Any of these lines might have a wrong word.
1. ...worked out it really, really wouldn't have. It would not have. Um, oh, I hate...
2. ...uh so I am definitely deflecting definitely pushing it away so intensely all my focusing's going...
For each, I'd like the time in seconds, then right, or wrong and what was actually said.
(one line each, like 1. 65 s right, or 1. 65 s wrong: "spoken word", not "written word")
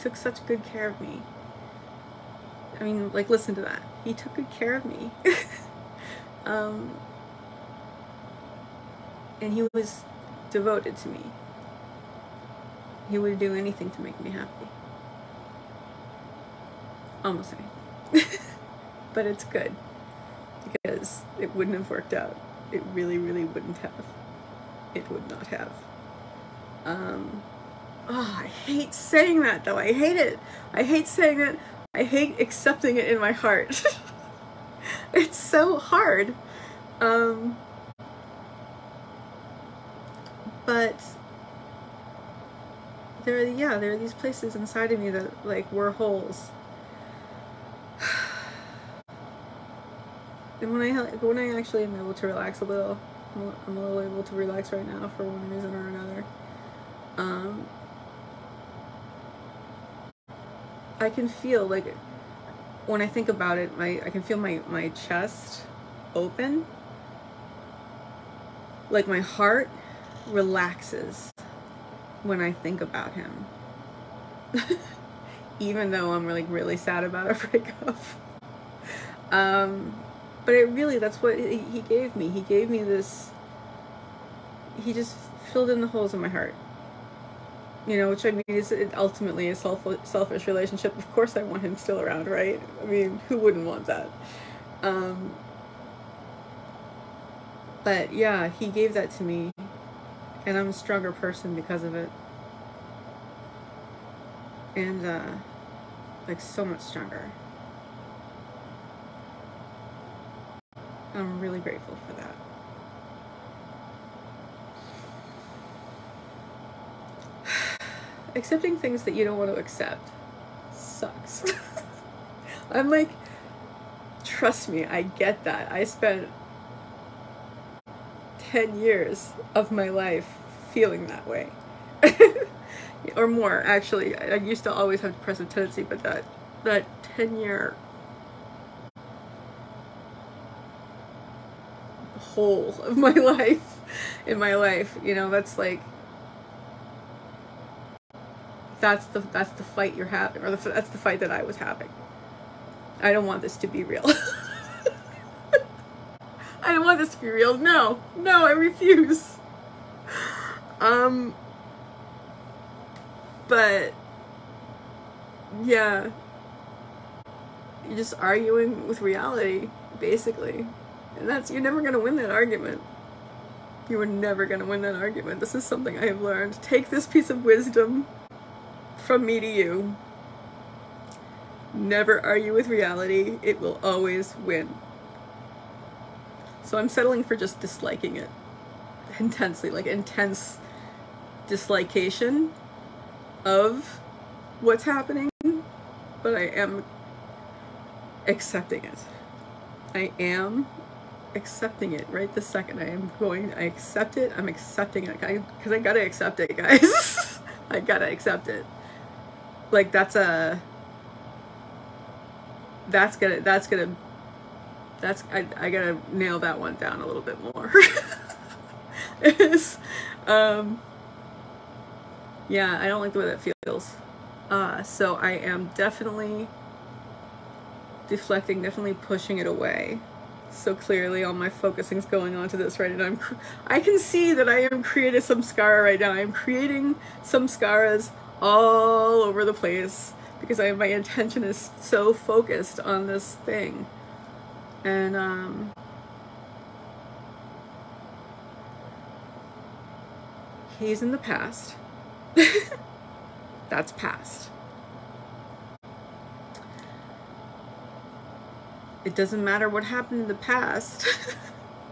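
1. 21 s right
2. 224 s wrong: "clearly", not "intensely".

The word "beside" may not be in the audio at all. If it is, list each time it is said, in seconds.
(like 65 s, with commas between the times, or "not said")
not said.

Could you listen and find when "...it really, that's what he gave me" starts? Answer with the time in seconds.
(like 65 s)
80 s.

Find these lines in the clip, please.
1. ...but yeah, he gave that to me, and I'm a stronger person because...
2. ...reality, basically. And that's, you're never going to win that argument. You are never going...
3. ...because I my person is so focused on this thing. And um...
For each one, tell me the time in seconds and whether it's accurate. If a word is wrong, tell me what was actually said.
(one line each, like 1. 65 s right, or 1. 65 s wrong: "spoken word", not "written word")
1. 97 s right
2. 169 s right
3. 240 s wrong: "intention", not "person".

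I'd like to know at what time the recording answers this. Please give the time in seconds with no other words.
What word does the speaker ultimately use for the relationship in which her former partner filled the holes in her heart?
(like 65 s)
90 s.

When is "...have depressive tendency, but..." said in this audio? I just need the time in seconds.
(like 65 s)
135 s.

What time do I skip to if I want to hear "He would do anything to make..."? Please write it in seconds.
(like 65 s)
13 s.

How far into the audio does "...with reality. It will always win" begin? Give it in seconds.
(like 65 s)
182 s.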